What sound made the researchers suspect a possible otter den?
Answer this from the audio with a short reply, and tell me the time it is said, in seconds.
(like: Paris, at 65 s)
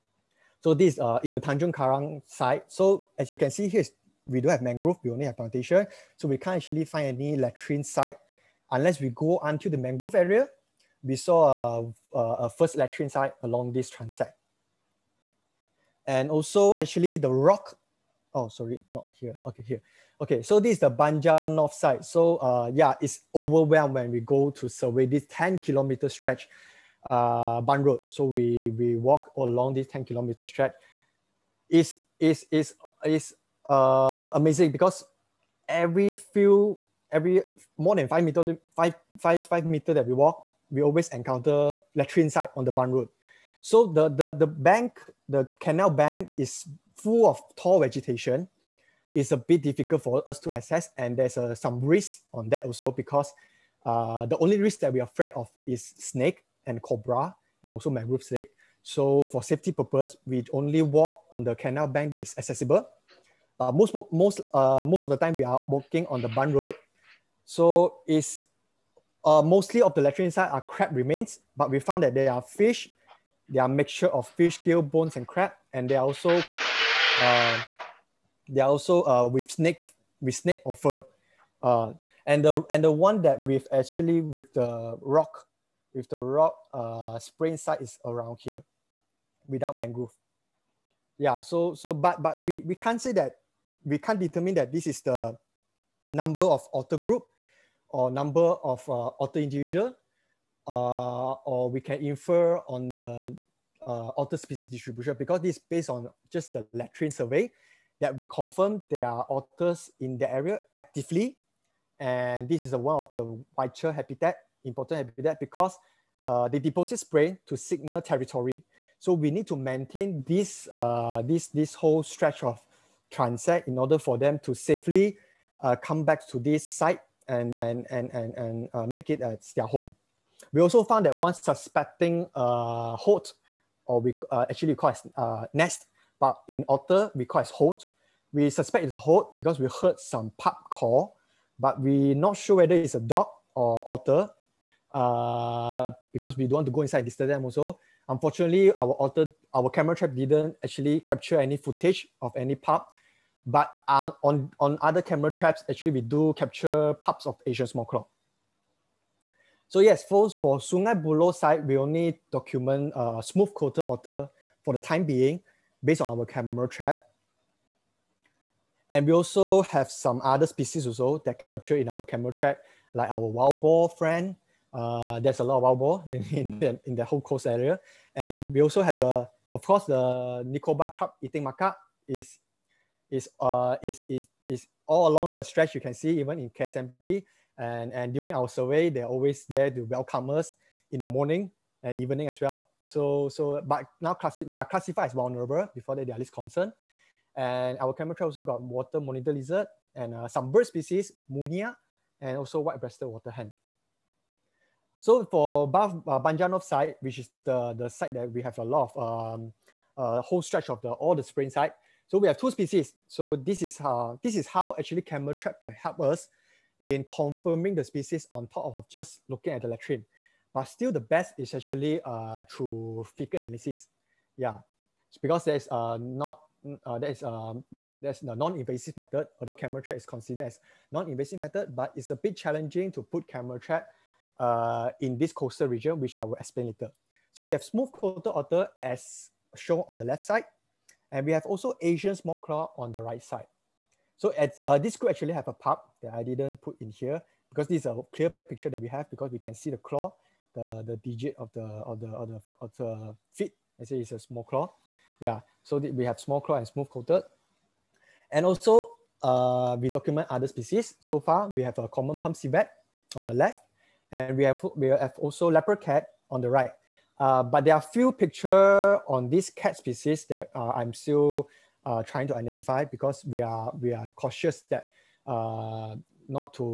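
Pup call, at 140 s.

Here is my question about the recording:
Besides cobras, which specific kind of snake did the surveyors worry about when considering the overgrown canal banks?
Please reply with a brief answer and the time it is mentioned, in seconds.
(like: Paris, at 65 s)
Mangrove snake, at 57 s.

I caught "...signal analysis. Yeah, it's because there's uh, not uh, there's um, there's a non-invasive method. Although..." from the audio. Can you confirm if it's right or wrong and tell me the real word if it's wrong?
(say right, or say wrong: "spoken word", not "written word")
wrong: "fecal", not "signal".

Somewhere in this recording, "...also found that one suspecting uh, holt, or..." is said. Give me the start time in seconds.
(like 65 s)
130 s.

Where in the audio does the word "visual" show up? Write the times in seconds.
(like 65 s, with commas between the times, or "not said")
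not said.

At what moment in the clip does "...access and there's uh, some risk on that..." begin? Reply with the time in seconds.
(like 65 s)
50 s.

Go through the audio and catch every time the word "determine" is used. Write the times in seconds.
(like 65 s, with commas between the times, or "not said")
94 s.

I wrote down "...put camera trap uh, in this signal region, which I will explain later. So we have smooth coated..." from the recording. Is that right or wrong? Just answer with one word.
wrong.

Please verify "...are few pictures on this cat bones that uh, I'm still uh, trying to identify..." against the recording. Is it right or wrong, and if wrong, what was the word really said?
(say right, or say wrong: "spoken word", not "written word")
wrong: "species", not "bones".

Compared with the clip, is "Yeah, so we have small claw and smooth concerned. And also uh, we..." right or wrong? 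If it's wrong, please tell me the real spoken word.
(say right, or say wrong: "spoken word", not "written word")
wrong: "coated", not "concerned".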